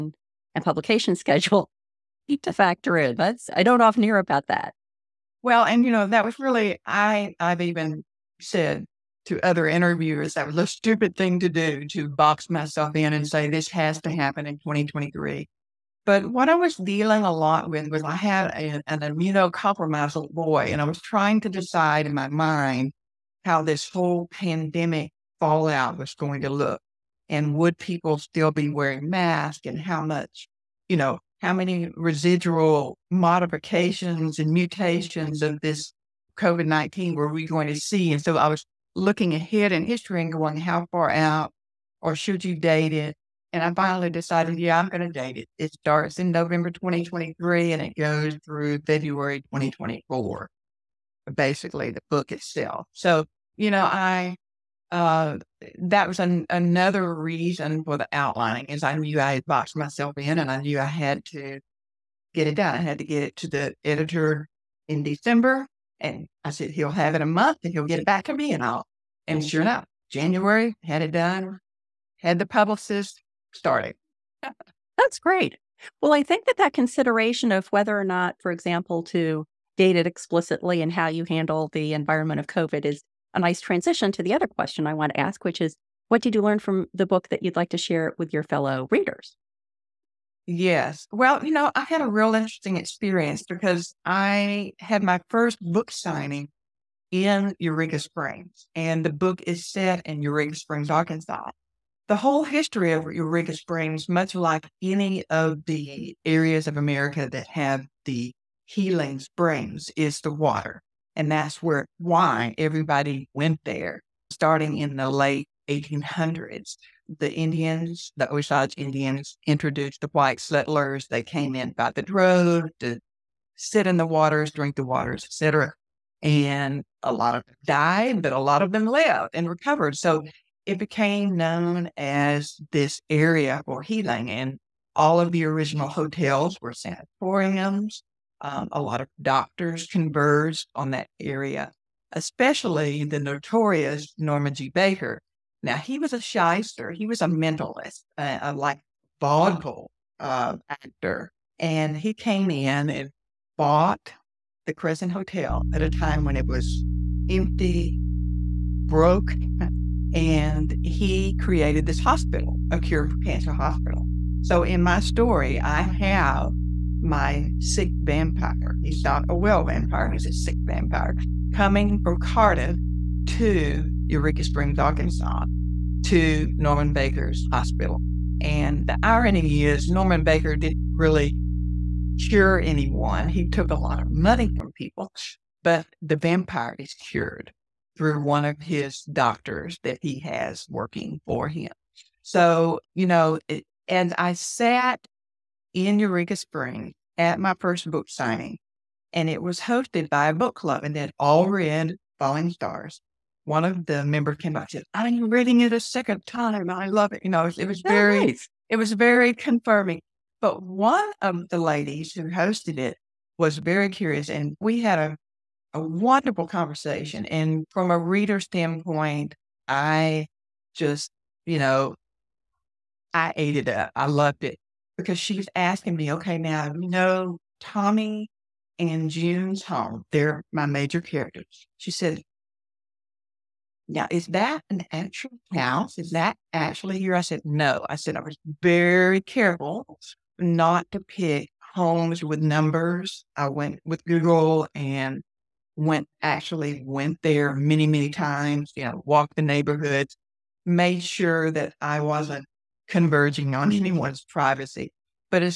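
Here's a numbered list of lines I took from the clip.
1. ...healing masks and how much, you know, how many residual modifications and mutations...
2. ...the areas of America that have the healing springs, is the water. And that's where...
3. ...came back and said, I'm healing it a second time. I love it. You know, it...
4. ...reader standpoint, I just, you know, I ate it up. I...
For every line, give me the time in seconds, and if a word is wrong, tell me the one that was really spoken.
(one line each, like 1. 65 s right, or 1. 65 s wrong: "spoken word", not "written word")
1. 28 s wrong: "wearing", not "healing"
2. 105 s right
3. 204 s wrong: "reading", not "healing"
4. 217 s right.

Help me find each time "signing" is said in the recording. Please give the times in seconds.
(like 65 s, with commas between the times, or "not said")
95 s, 198 s.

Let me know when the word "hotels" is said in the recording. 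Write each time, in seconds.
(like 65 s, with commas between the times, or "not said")
135 s, 155 s.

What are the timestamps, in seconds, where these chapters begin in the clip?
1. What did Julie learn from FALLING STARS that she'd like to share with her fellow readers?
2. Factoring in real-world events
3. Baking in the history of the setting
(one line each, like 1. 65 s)
1. 74 s
2. 15 s
3. 101 s.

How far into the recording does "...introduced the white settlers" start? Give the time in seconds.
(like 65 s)
119 s.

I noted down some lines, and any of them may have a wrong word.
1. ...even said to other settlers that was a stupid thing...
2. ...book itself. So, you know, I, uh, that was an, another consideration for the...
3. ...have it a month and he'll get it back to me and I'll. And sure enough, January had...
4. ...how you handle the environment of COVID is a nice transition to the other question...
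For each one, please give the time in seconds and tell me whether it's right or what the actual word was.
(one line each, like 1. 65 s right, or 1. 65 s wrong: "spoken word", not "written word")
1. 7 s wrong: "interviewers", not "settlers"
2. 52 s wrong: "reason", not "consideration"
3. 66 s right
4. 80 s right.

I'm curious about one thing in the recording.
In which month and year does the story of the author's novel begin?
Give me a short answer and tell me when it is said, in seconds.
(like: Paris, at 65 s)
November 2023, at 46 s.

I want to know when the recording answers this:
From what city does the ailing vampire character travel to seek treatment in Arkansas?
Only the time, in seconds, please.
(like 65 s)
172 s.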